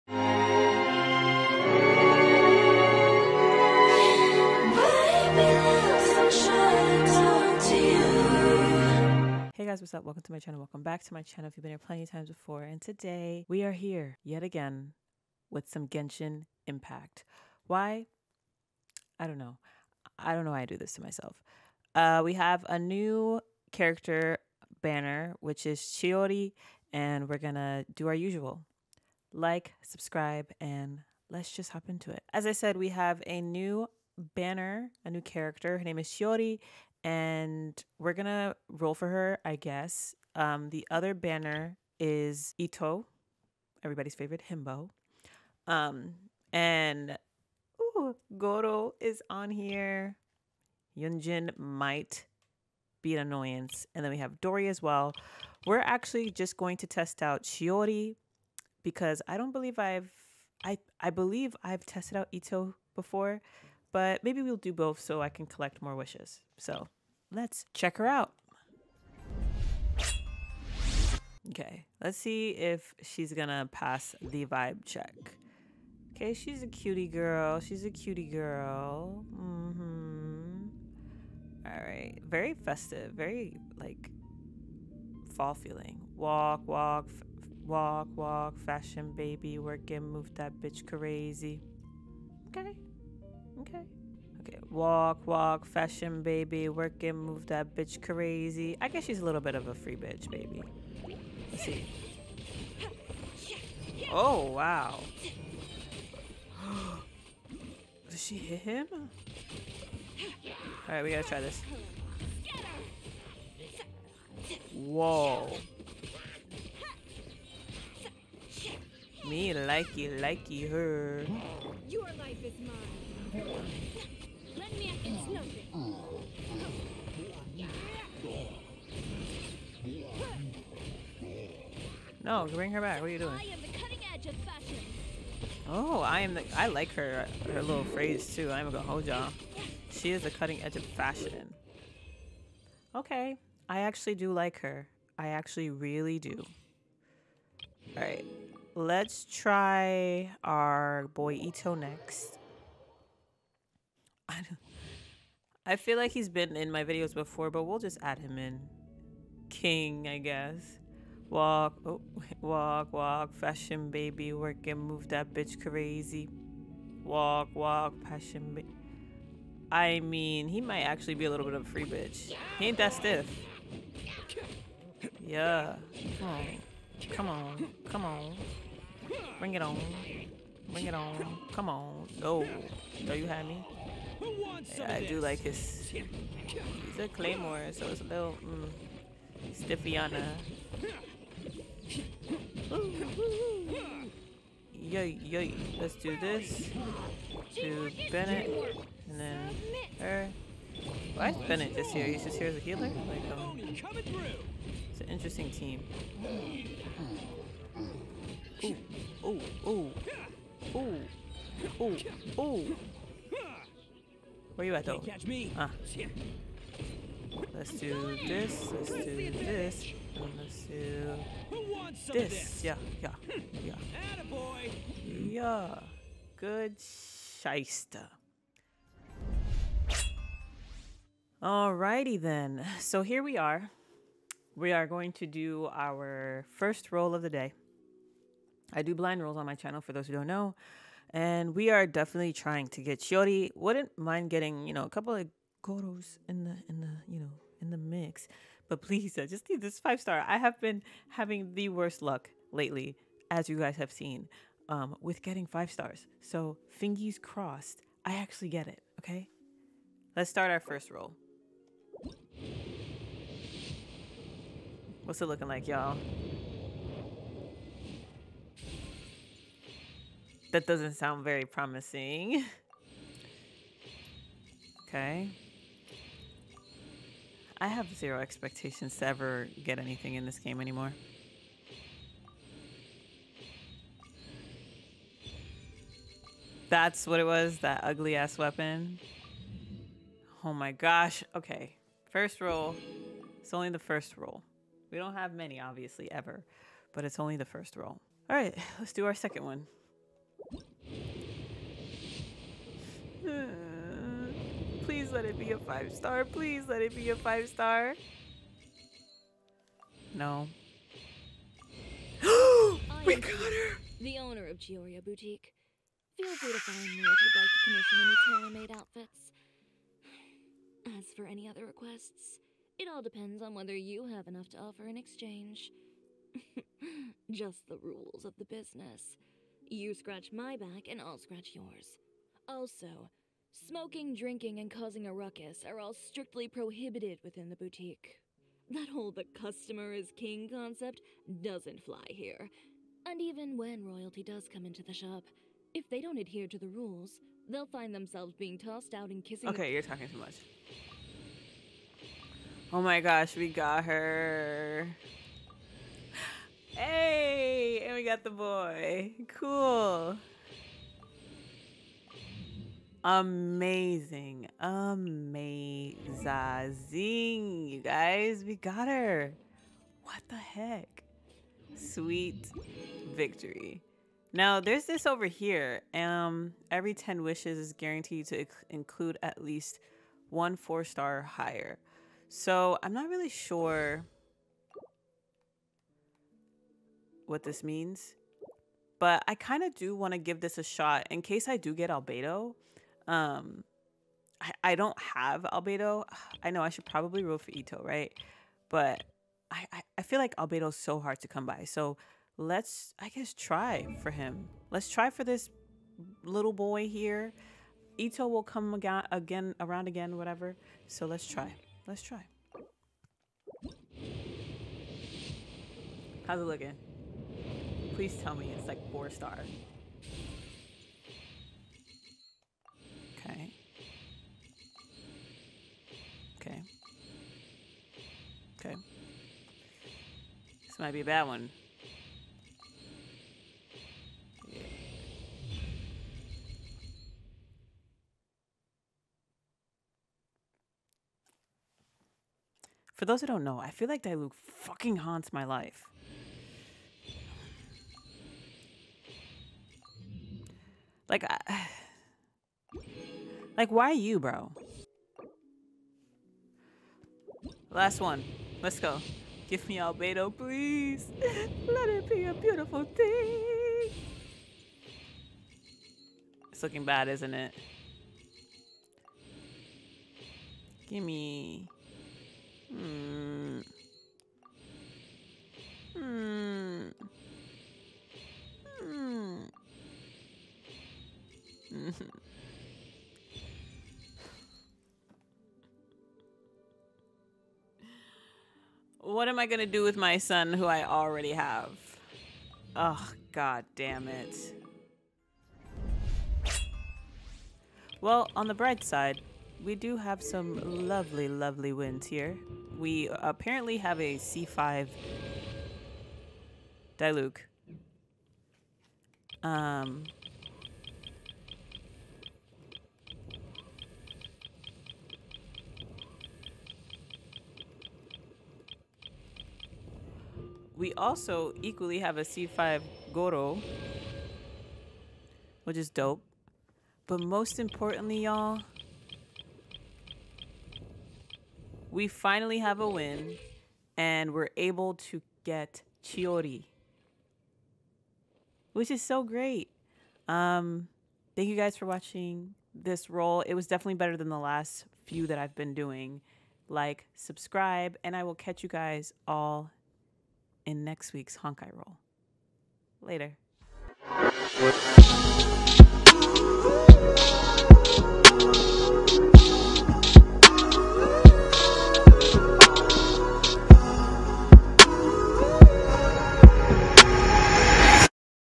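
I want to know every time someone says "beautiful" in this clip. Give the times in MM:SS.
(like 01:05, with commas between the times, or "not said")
07:42.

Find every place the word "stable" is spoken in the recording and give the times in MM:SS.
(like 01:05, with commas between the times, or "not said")
not said.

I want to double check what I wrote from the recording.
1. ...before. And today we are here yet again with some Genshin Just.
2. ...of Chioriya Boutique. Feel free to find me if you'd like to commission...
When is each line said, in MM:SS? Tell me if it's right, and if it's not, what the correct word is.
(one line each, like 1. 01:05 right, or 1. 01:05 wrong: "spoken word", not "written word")
1. 00:12 wrong: "Impact", not "Just"
2. 05:14 right.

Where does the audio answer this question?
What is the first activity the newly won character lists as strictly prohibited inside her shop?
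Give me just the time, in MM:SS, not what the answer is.
05:33.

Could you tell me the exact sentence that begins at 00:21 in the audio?
Uh, we have a new character banner, which is Chiori, and we're gonna do our usual.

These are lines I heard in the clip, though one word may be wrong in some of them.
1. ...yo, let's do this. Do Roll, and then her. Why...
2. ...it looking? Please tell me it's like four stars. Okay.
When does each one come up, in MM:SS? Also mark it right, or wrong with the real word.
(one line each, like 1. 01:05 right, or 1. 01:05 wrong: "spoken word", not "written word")
1. 03:15 wrong: "Bennett", not "Roll"
2. 06:56 right.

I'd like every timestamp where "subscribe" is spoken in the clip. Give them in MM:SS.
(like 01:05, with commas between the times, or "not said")
00:29, 09:07.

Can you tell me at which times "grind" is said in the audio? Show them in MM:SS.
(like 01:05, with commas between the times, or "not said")
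not said.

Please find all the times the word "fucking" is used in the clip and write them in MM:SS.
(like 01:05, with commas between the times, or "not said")
07:24.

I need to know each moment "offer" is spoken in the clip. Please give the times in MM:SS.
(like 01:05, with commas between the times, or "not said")
05:24.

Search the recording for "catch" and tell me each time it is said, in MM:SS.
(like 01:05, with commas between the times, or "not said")
03:34, 09:08.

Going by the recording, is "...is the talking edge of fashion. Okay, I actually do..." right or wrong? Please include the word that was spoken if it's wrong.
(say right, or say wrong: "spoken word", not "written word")
wrong: "cutting", not "talking".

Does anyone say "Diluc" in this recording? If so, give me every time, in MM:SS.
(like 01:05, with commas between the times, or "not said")
07:24, 08:26.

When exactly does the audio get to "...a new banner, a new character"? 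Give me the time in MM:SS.
00:33.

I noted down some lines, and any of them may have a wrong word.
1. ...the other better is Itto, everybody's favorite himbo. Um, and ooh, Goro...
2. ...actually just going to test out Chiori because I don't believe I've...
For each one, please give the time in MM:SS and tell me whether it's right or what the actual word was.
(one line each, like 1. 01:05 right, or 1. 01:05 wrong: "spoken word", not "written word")
1. 00:40 wrong: "banner", not "better"
2. 00:55 right.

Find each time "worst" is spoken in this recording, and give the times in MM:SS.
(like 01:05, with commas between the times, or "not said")
04:11.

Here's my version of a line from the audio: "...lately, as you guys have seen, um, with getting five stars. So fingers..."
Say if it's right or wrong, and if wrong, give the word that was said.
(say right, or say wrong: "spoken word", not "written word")
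right.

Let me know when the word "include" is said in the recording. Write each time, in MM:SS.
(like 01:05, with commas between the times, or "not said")
06:18.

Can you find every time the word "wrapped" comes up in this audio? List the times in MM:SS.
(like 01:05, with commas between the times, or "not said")
not said.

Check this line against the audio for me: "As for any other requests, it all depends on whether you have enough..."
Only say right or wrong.
right.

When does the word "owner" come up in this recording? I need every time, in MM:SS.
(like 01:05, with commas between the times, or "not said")
05:14.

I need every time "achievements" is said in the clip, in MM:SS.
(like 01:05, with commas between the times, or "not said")
not said.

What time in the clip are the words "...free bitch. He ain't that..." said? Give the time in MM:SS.
02:51.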